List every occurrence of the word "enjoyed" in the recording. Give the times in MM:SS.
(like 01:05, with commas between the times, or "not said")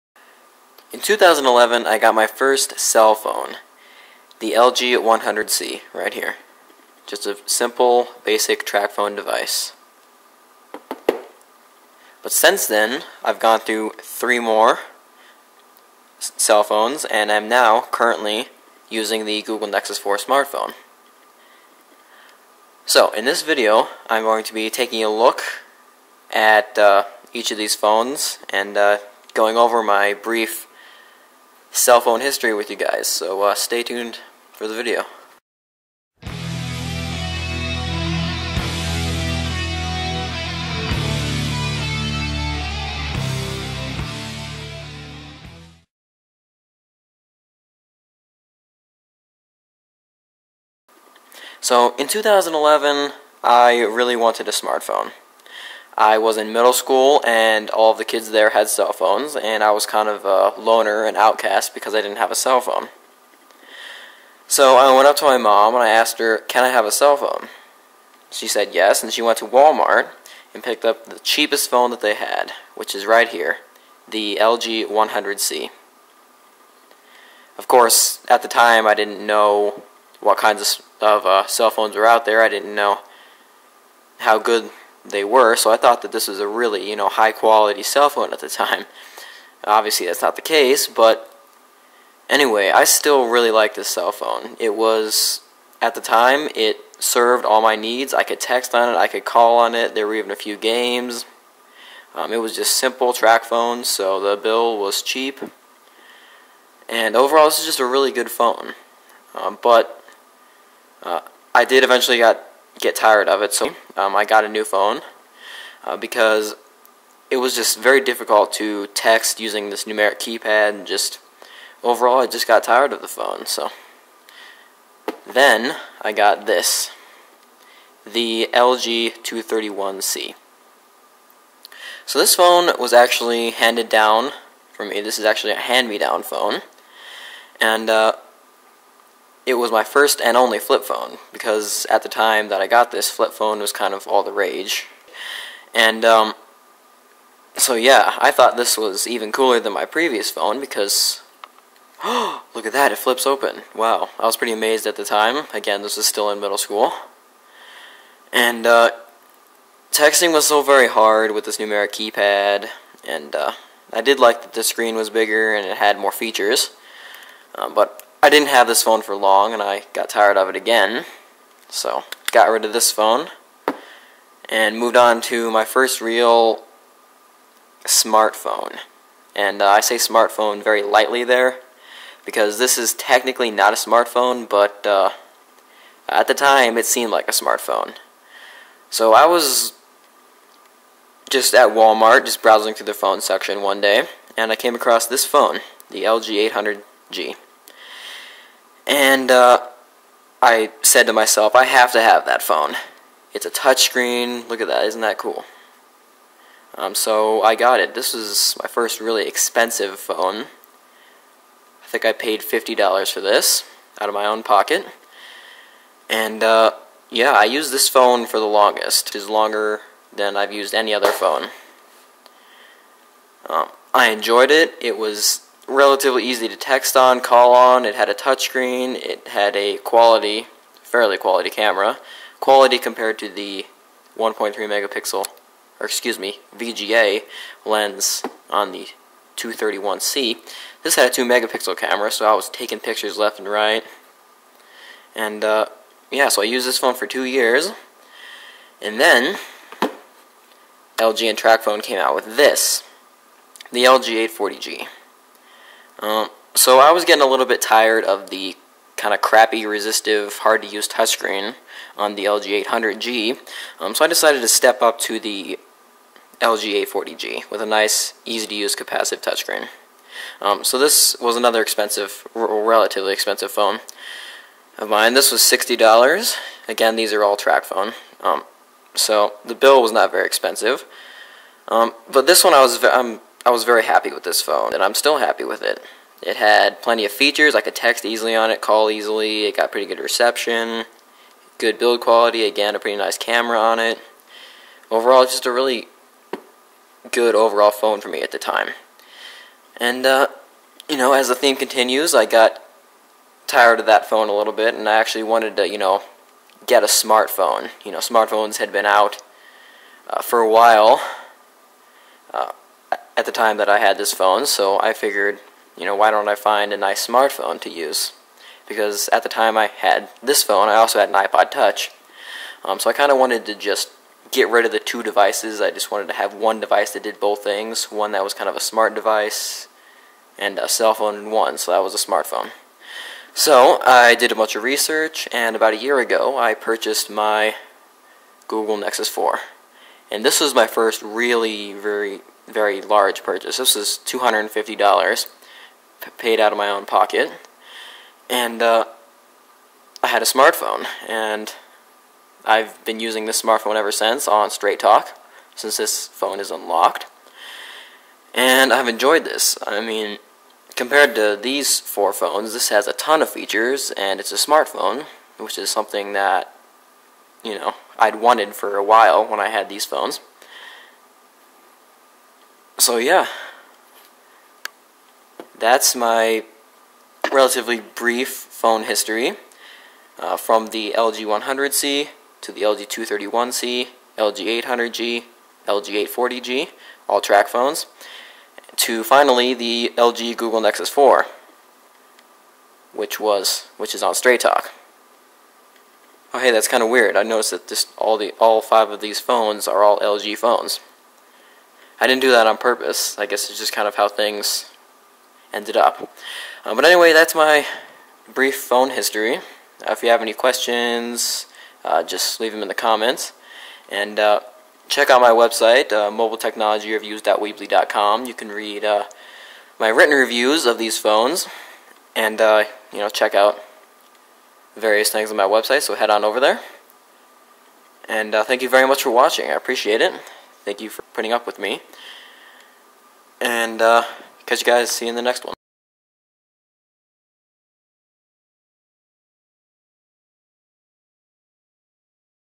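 03:44, 05:58.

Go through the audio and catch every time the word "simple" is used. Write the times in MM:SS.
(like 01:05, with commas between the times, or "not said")
00:07, 01:42.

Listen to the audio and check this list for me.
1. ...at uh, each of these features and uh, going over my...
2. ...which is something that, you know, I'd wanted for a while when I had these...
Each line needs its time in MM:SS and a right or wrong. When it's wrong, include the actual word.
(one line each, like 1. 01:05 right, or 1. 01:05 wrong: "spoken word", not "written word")
1. 00:26 wrong: "phones", not "features"
2. 06:05 right.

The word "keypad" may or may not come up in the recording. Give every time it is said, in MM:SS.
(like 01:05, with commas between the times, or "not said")
02:00, 02:41.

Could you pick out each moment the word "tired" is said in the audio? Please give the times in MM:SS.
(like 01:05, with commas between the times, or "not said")
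01:52, 02:02, 02:50, 04:17, 05:03.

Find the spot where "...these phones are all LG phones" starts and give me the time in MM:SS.
06:39.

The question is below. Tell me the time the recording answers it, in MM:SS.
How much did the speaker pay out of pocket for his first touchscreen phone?
03:32.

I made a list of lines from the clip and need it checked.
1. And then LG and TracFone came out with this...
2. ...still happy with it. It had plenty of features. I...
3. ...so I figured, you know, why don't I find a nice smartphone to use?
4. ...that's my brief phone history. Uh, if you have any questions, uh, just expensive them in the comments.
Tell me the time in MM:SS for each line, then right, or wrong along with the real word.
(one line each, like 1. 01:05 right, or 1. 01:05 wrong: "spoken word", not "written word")
1. 04:08 right
2. 04:44 right
3. 05:14 right
4. 06:47 wrong: "leave", not "expensive".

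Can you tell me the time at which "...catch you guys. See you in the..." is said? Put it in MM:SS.
07:14.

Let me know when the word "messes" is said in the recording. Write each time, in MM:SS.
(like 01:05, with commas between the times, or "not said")
not said.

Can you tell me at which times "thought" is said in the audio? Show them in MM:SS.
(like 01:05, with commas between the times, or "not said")
01:25, 02:28.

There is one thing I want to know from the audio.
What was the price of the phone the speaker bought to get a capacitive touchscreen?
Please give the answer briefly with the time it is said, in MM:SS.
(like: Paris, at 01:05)
$60, at 04:35.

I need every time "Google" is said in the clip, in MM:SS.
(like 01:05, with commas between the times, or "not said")
00:19, 05:38, 06:30.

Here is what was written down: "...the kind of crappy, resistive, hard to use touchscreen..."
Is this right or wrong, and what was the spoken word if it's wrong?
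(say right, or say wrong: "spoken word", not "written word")
right.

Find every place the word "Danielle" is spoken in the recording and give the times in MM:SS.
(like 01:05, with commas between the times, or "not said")
not said.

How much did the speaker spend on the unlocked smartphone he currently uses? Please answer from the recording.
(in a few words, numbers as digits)
$250.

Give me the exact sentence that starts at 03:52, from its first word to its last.
Quality compared to the 1.3 megapixel, or excuse me, VGA lens on the 231C.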